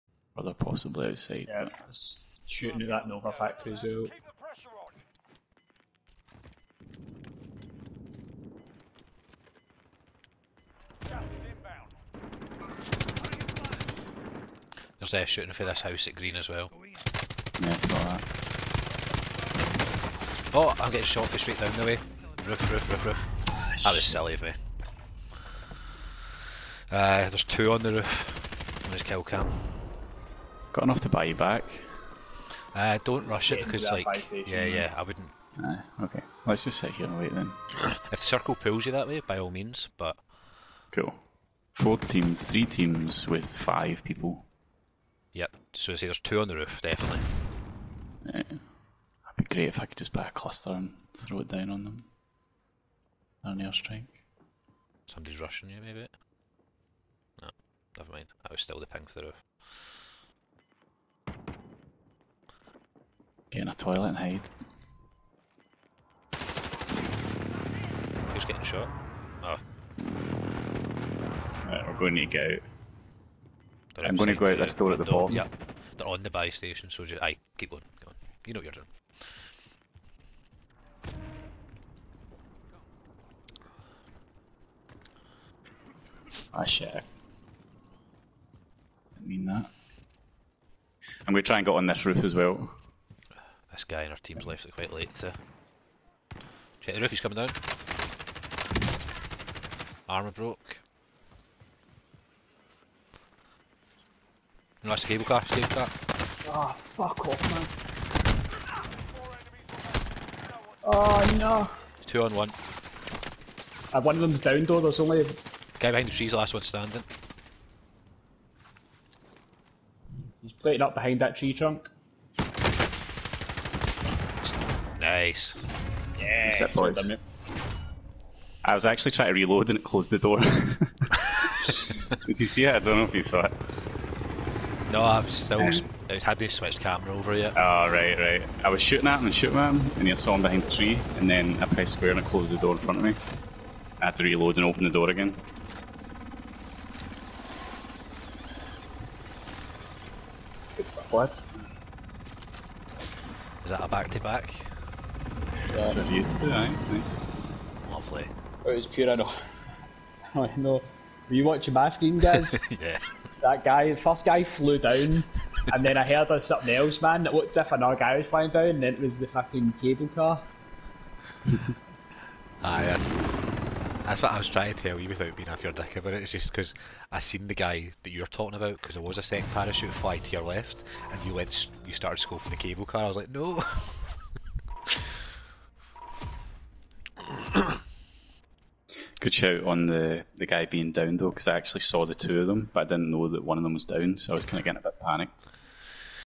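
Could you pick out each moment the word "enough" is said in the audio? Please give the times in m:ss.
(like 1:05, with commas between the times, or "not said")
0:30.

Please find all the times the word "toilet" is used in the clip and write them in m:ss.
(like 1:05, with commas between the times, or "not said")
1:03.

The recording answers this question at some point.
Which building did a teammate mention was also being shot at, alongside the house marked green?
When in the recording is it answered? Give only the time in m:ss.
0:03.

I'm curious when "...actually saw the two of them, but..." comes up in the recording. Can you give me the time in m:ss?
3:11.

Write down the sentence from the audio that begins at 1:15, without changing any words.
Yeah, they're on the buy station, so just aye, keep going, Come on.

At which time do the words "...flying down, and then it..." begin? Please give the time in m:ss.
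2:48.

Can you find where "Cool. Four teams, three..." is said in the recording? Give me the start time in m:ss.
0:40.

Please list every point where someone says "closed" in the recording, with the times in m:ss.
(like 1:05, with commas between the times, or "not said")
2:09, 2:22.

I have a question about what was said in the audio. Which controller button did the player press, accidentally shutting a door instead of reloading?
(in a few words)
Square.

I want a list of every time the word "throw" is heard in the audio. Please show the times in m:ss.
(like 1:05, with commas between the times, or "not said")
0:51.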